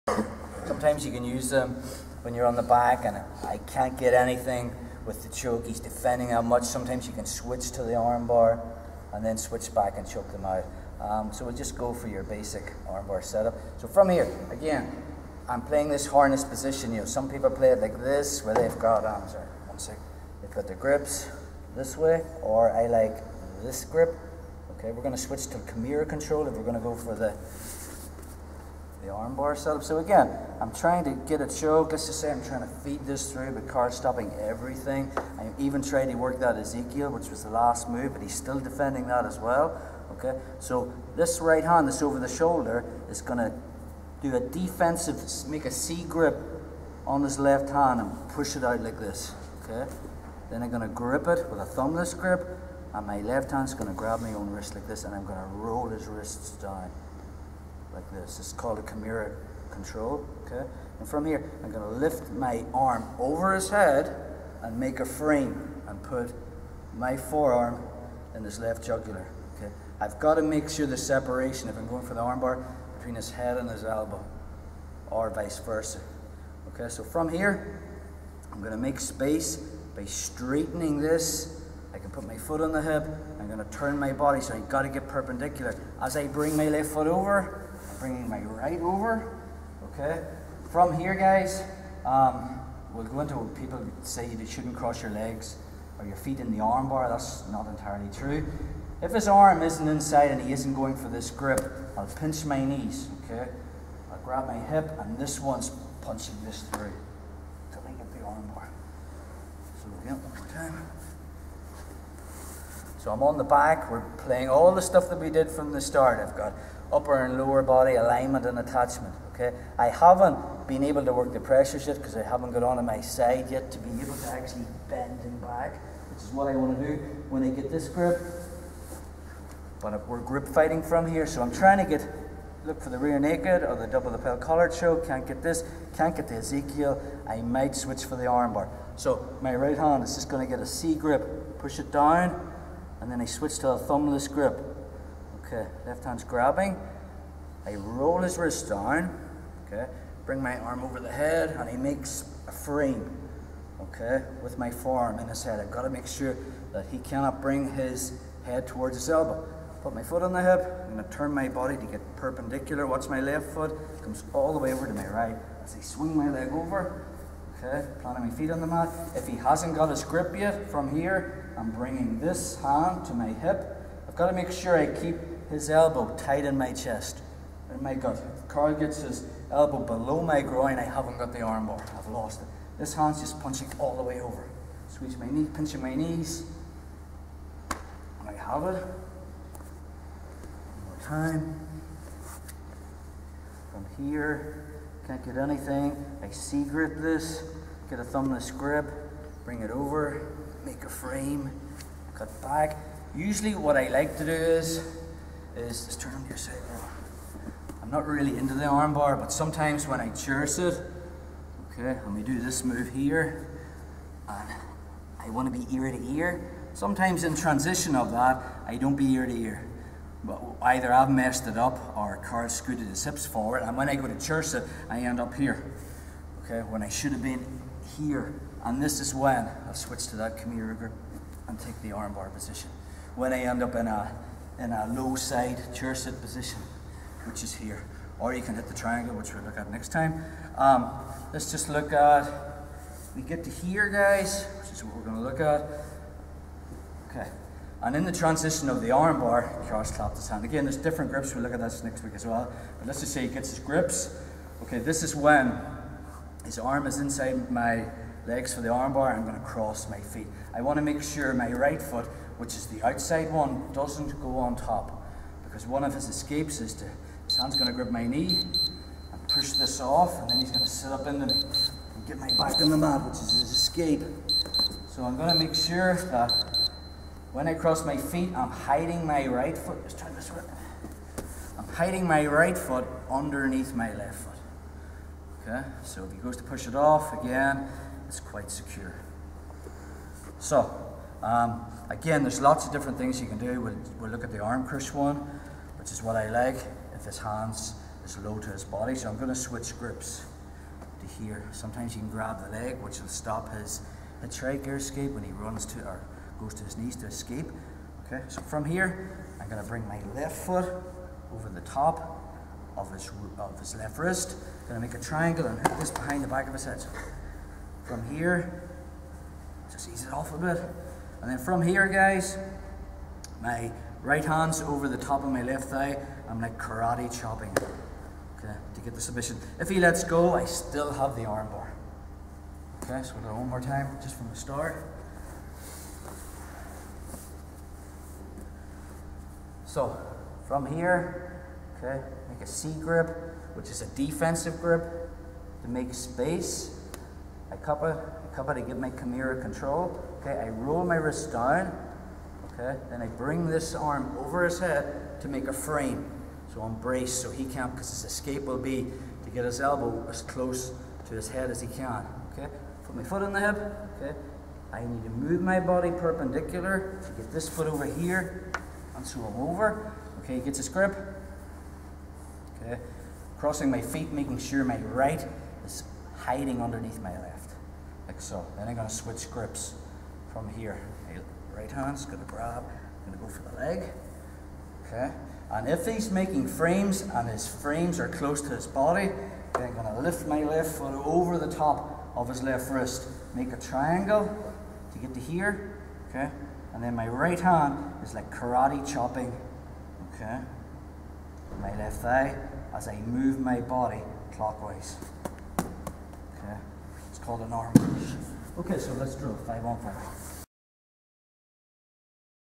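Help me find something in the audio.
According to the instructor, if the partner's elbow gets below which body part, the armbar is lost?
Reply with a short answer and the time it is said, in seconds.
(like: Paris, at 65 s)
Groin, at 180 s.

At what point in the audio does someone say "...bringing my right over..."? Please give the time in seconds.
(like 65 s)
88 s.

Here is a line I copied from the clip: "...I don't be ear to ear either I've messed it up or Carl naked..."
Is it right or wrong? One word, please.
wrong.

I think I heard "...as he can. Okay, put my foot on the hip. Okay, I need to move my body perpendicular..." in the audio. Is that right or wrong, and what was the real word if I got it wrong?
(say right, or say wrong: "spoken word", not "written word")
right.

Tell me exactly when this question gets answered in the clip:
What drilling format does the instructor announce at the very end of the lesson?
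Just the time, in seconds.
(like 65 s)
409 s.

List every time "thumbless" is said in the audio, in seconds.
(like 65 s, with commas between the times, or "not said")
51 s, 143 s, 198 s.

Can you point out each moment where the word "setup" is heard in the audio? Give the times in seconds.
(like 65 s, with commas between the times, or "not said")
13 s, 29 s.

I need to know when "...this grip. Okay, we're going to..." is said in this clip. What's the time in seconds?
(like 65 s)
23 s.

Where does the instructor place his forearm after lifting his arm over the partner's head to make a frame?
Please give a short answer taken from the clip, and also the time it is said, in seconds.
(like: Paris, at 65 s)
Left jugular, at 68 s.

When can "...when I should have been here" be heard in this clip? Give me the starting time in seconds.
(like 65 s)
226 s.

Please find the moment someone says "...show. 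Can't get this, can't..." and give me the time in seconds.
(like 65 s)
134 s.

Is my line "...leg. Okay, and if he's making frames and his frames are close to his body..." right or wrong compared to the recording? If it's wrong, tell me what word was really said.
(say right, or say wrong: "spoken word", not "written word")
right.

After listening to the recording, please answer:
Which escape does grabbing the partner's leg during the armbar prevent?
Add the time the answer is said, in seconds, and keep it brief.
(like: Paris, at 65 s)
Hitchhiker escape, at 304 s.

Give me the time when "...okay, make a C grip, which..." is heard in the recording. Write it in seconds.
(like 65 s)
341 s.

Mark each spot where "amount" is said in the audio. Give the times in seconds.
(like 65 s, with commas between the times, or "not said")
not said.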